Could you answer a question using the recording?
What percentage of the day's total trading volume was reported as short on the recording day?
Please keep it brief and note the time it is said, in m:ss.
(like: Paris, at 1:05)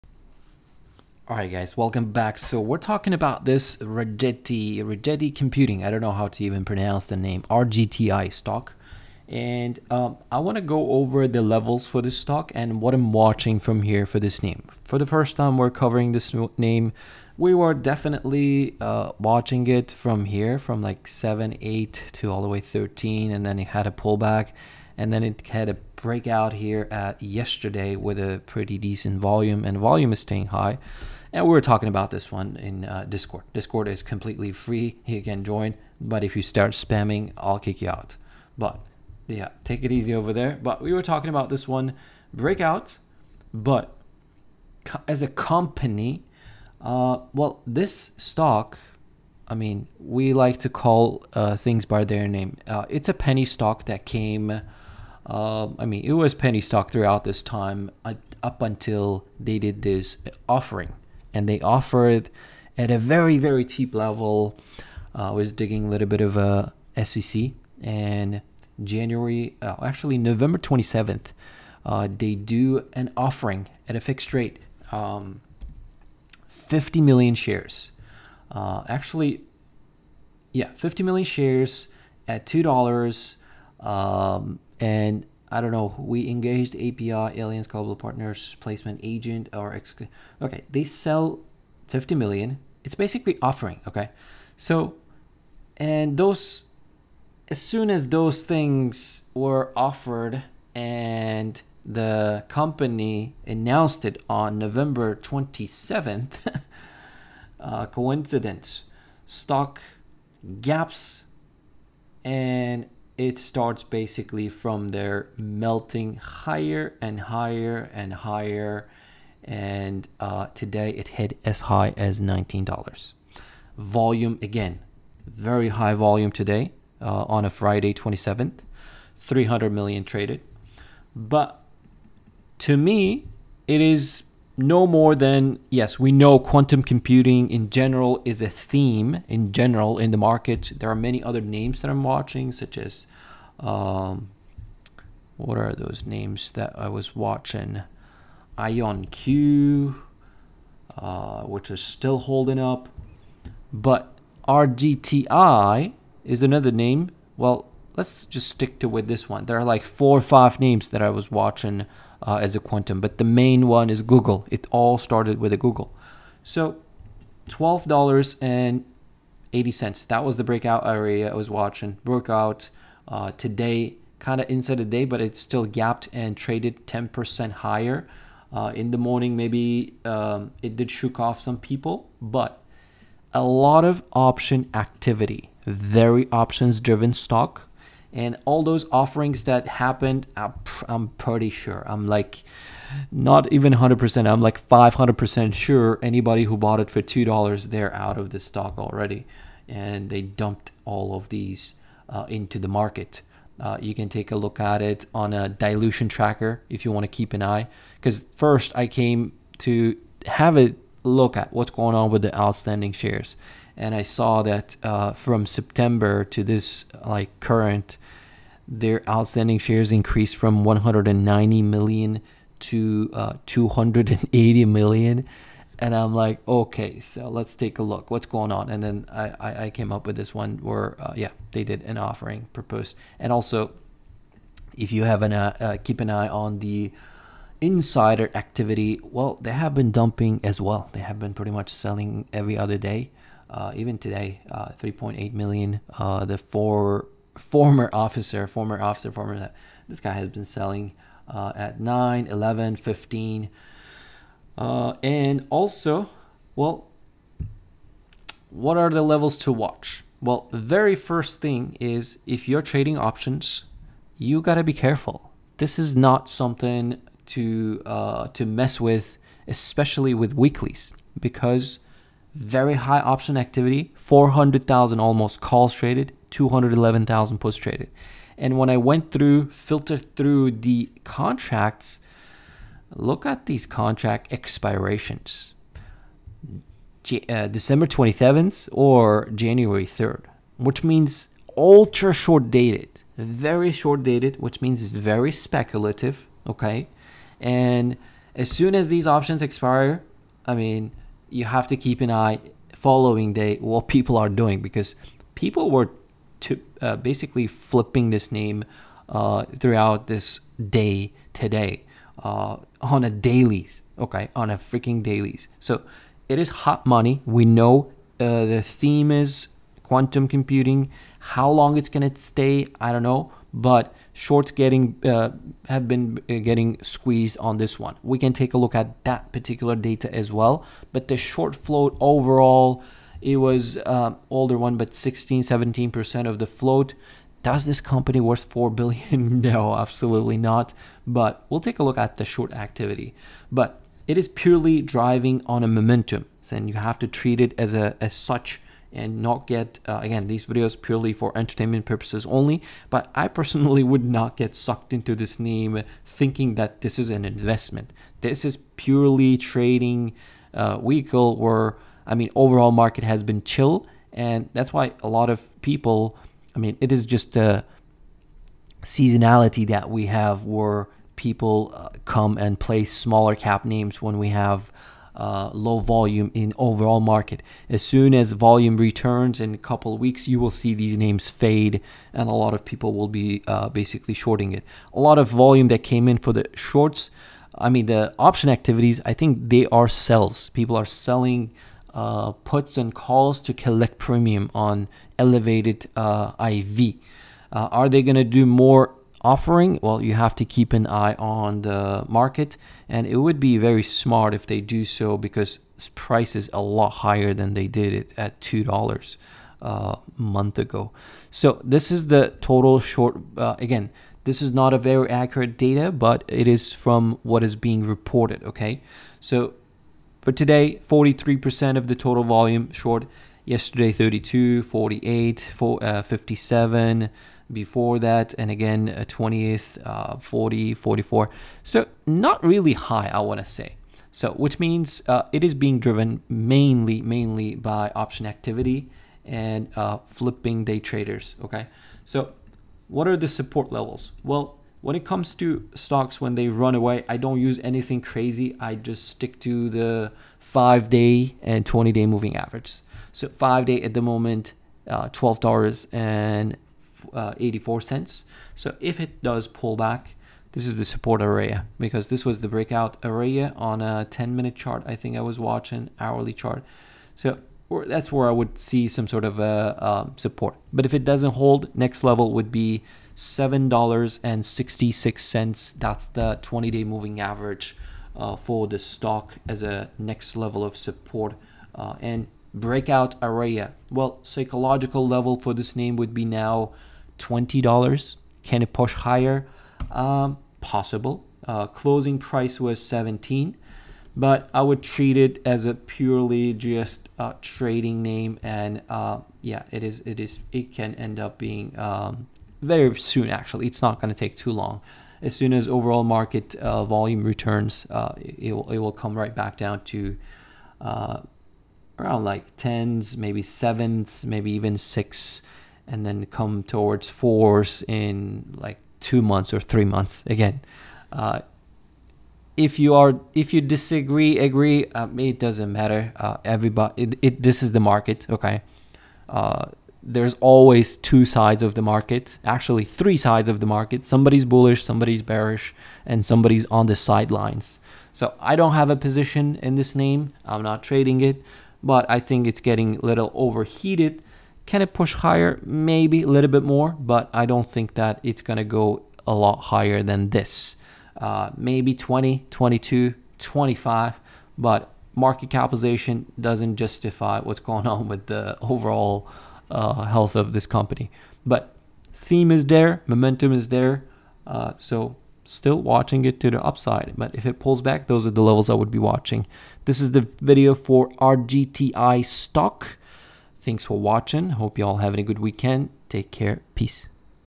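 43%, at 7:00.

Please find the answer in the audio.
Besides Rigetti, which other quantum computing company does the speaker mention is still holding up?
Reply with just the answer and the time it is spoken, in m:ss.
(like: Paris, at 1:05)
IonQ, at 2:28.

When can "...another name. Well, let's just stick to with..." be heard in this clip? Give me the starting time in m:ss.
2:36.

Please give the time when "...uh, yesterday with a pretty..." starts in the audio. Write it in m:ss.
0:27.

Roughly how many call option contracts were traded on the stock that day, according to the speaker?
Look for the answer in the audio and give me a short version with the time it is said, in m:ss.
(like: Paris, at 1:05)
400,000, at 4:33.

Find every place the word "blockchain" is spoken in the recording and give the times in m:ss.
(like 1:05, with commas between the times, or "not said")
not said.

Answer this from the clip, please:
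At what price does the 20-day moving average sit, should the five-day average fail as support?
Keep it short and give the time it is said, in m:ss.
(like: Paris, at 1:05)
$7.66, at 7:53.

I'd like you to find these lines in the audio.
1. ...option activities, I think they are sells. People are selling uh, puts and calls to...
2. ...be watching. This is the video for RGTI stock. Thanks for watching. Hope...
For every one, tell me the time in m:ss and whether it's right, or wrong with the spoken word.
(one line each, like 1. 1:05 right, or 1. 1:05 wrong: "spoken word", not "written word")
1. 6:28 right
2. 9:28 right.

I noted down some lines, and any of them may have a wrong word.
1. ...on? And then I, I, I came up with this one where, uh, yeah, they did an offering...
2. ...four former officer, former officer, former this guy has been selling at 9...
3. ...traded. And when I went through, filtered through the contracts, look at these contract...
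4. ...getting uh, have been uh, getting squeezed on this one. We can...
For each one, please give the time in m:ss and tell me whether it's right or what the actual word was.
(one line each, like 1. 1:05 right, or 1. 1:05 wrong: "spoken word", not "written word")
1. 3:48 right
2. 4:06 right
3. 4:37 right
4. 5:24 right.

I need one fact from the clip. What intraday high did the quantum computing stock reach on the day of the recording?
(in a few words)
$19.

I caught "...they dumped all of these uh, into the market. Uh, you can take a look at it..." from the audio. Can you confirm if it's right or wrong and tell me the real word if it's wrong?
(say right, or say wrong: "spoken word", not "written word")
right.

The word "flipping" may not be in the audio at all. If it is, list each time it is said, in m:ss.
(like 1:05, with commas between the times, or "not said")
5:07, 7:20.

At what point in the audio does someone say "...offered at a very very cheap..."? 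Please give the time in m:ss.
1:01.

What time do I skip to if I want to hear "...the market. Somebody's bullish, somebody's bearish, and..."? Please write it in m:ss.
8:53.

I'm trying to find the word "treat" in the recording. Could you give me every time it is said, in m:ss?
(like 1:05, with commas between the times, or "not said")
5:47, 8:14.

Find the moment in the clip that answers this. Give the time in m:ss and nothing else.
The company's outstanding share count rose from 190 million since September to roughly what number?
3:43.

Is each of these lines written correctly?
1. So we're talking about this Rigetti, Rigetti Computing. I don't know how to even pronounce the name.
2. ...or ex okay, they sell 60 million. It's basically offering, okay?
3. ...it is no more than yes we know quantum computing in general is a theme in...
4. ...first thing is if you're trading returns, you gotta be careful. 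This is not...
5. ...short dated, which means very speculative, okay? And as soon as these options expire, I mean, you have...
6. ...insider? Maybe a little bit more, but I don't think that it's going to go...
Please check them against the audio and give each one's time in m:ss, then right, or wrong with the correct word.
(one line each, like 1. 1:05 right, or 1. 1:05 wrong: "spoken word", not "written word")
1. 0:02 right
2. 1:29 wrong: "50", not "60"
3. 2:13 right
4. 4:20 wrong: "options", not "returns"
5. 4:53 right
6. 9:05 wrong: "higher", not "insider".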